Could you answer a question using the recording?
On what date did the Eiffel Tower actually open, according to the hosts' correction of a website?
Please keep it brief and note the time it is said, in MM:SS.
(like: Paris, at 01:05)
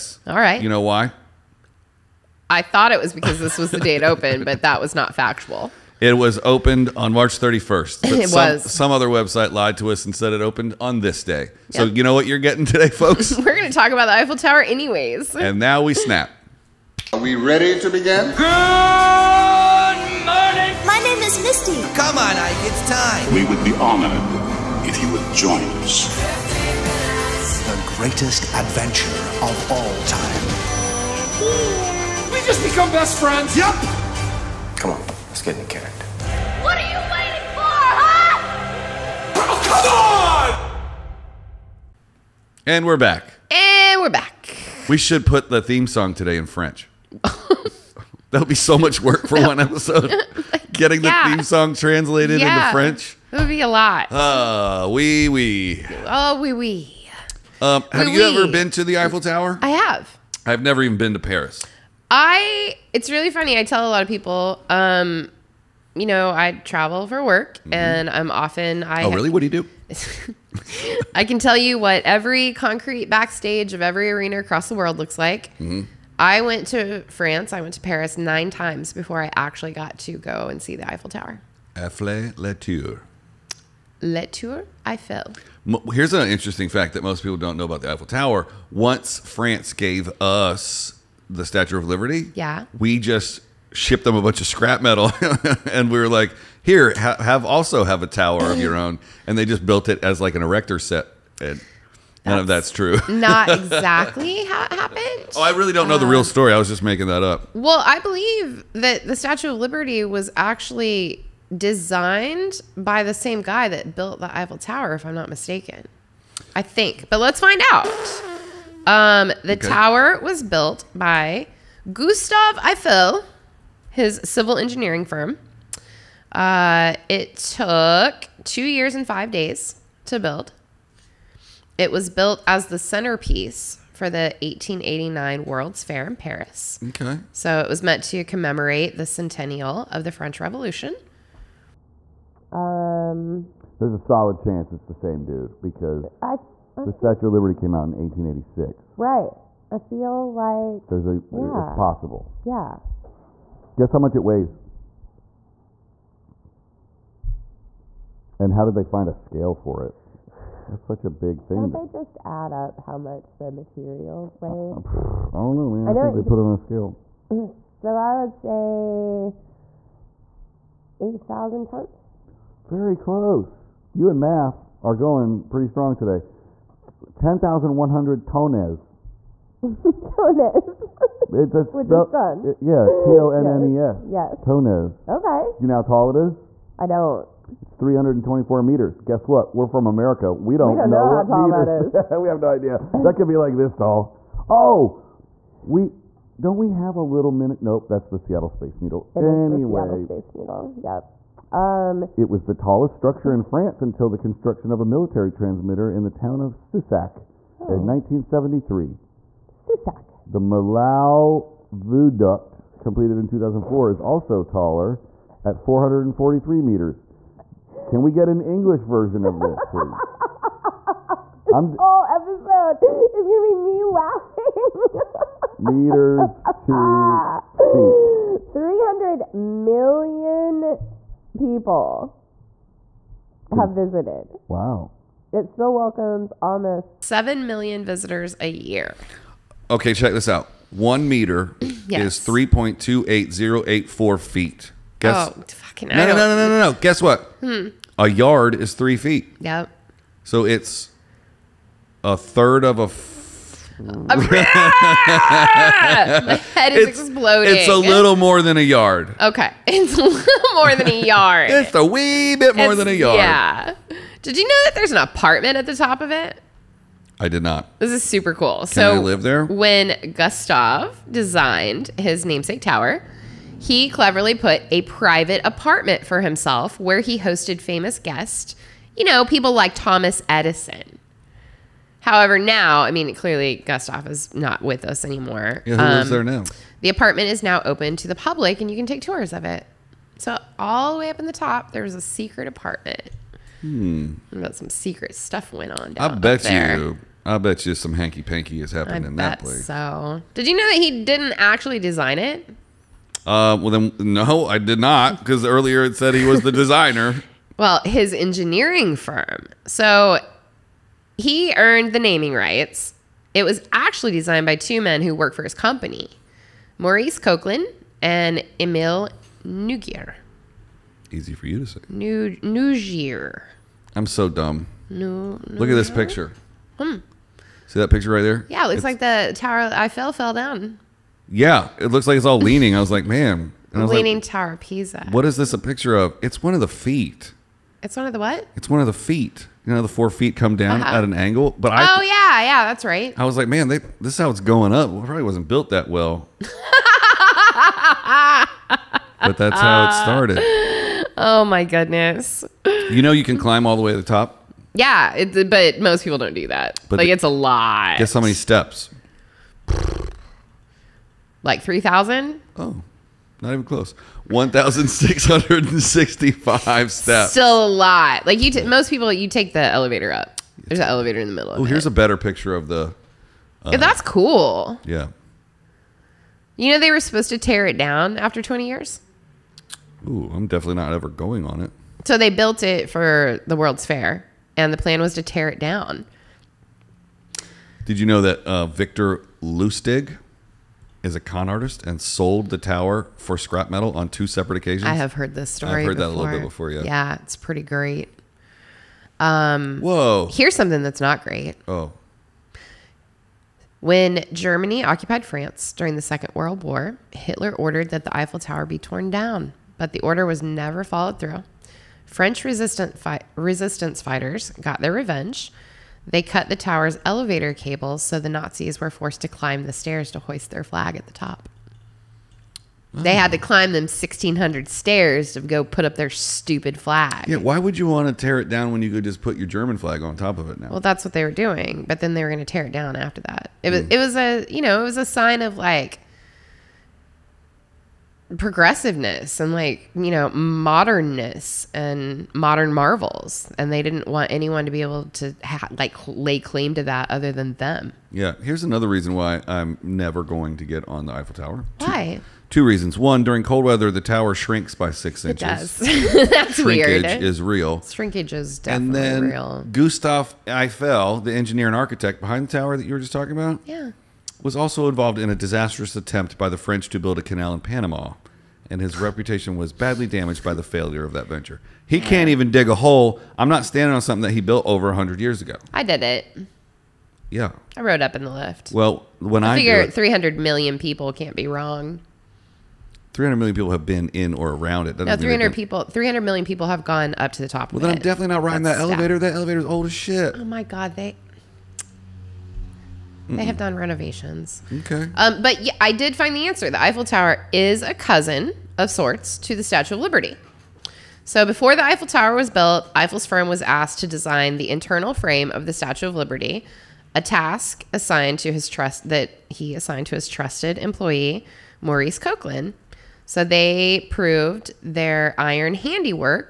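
March 31st, at 00:07.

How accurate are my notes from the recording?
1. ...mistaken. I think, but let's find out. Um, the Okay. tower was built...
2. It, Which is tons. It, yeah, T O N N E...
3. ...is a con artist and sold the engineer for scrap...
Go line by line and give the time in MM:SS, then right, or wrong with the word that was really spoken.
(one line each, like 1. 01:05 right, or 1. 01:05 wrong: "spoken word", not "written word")
1. 01:55 right
2. 02:59 right
3. 06:31 wrong: "tower", not "engineer".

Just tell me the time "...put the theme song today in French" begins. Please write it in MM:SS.
00:45.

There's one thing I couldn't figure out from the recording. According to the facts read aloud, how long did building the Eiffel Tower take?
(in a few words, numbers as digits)
2 years and 5 days.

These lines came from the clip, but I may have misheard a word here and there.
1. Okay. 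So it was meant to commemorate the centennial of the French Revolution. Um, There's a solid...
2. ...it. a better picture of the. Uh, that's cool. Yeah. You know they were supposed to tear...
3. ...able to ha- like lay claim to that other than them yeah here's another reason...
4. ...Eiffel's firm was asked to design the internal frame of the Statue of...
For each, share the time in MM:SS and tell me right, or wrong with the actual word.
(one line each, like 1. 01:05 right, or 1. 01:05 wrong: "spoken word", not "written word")
1. 02:16 right
2. 06:11 right
3. 07:24 right
4. 08:22 right.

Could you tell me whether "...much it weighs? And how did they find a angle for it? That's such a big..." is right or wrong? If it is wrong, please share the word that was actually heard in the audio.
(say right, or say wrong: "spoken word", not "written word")
wrong: "scale", not "angle".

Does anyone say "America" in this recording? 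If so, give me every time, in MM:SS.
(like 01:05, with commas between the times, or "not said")
03:09.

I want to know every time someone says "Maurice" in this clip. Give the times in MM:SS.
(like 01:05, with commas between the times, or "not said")
05:16, 08:31.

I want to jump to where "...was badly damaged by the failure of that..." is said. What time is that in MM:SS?
07:49.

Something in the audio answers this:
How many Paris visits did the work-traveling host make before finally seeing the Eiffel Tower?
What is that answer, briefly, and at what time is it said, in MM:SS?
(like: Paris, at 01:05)
9, at 01:18.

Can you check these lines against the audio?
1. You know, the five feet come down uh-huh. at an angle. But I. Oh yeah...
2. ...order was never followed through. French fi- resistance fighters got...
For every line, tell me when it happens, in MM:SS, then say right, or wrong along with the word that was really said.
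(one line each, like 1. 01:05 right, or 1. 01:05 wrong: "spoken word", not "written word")
1. 05:39 wrong: "four", not "five"
2. 06:50 right.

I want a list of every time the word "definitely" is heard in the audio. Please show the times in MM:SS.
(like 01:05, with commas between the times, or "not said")
06:20, 07:38, 08:08.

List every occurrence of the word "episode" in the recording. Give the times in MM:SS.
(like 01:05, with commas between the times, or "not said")
00:49, 03:42.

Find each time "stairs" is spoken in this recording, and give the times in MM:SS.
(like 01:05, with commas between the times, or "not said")
06:59, 07:04.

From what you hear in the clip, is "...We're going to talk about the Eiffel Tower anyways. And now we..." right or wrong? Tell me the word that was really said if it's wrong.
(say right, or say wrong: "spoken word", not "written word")
right.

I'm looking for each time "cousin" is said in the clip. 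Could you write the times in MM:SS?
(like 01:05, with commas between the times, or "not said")
08:17.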